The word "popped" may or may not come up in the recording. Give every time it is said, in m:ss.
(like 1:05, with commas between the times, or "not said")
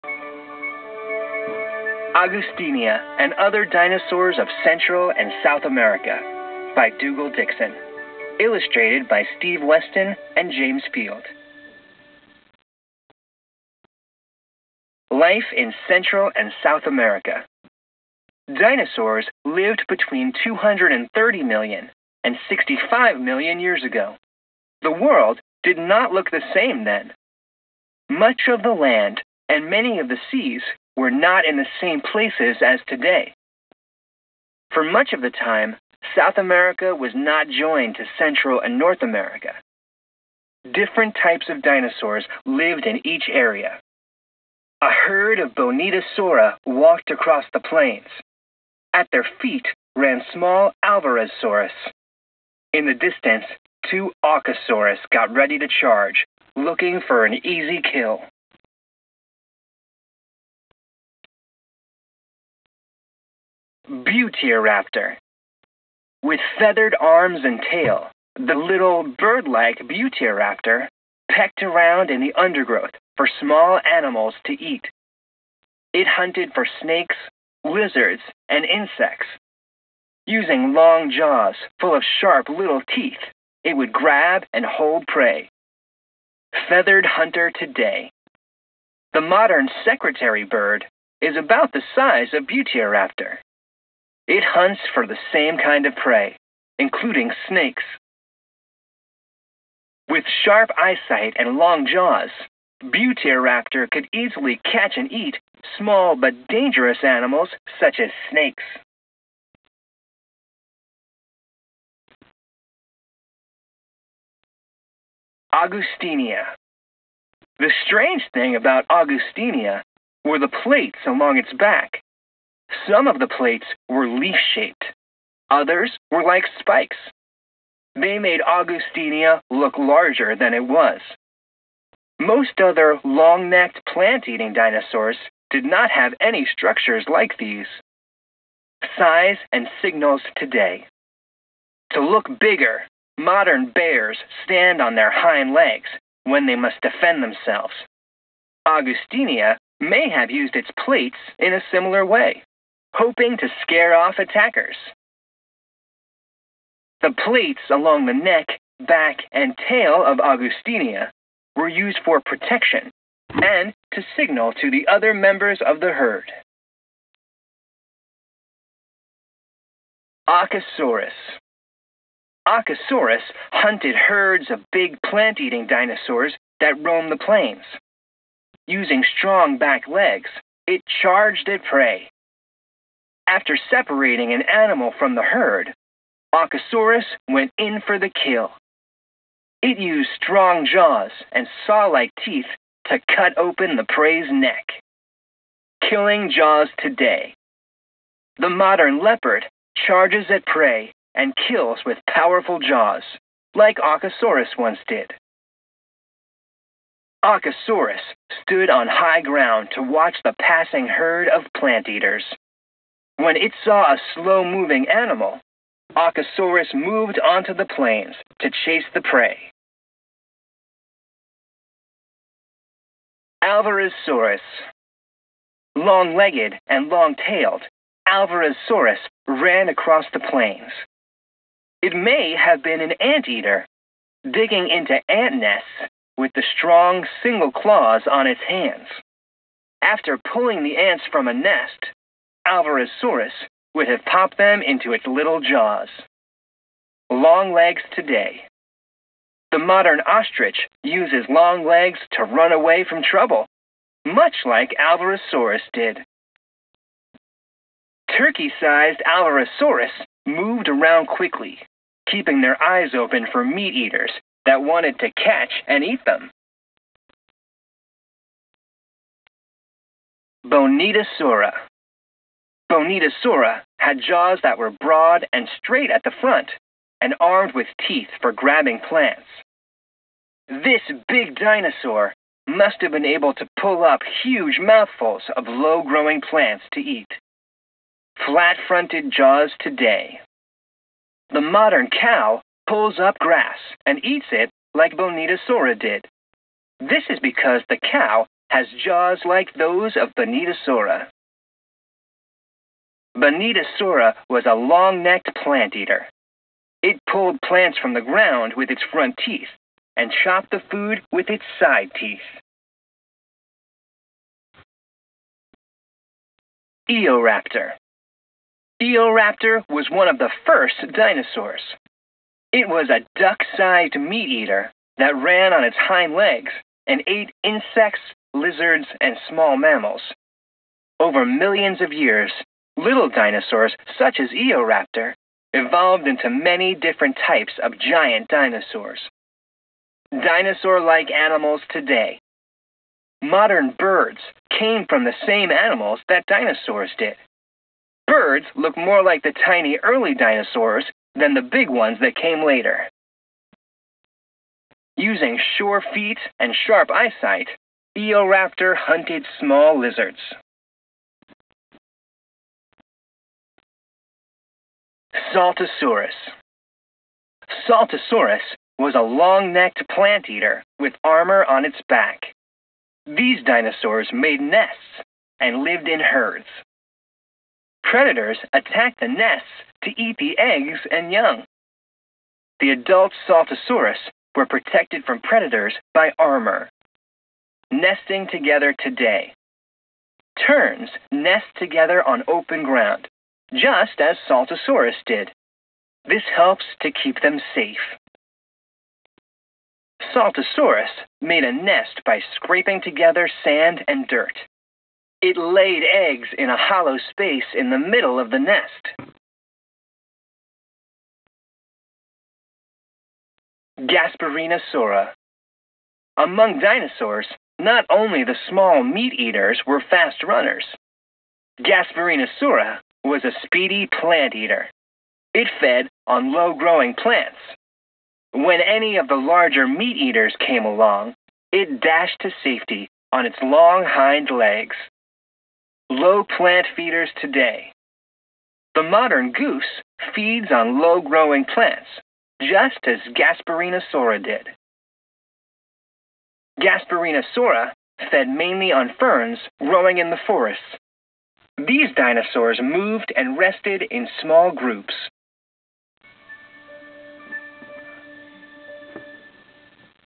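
4:04.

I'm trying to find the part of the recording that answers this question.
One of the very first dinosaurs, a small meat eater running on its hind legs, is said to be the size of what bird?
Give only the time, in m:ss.
5:23.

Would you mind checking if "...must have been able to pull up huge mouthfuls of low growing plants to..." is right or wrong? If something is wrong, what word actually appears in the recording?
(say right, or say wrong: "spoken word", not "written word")
right.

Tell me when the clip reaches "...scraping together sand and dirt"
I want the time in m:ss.
6:42.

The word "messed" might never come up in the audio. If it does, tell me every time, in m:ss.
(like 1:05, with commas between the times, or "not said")
not said.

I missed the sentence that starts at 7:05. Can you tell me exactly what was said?
It fed on low growing plants.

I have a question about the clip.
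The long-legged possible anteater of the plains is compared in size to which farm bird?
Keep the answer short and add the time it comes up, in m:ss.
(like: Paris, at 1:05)
turkey, at 4:18.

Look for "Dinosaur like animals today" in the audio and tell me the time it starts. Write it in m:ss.
5:40.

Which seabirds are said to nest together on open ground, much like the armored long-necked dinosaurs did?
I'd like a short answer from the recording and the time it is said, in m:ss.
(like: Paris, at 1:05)
terns, at 6:30.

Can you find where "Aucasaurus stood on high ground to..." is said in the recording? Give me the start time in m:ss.
3:27.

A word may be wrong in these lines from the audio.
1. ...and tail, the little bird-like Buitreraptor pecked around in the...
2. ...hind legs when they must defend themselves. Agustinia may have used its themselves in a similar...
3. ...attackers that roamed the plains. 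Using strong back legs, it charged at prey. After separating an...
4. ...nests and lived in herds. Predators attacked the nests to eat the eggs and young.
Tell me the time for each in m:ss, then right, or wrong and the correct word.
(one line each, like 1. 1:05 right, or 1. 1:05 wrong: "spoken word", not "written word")
1. 1:07 right
2. 2:25 wrong: "plates", not "themselves"
3. 2:55 wrong: "dinosaurs", not "attackers"
4. 6:14 right.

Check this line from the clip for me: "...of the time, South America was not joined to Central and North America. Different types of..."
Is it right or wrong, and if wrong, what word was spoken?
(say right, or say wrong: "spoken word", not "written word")
right.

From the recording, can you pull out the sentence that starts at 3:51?
It may have been an anteater, digging into ant nests with the strong single claws on its hands.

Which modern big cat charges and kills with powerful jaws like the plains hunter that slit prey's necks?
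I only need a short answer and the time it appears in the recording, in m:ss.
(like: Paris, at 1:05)
leopard, at 3:19.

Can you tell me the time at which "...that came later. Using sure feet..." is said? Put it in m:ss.
5:51.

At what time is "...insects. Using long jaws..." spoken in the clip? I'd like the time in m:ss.
1:18.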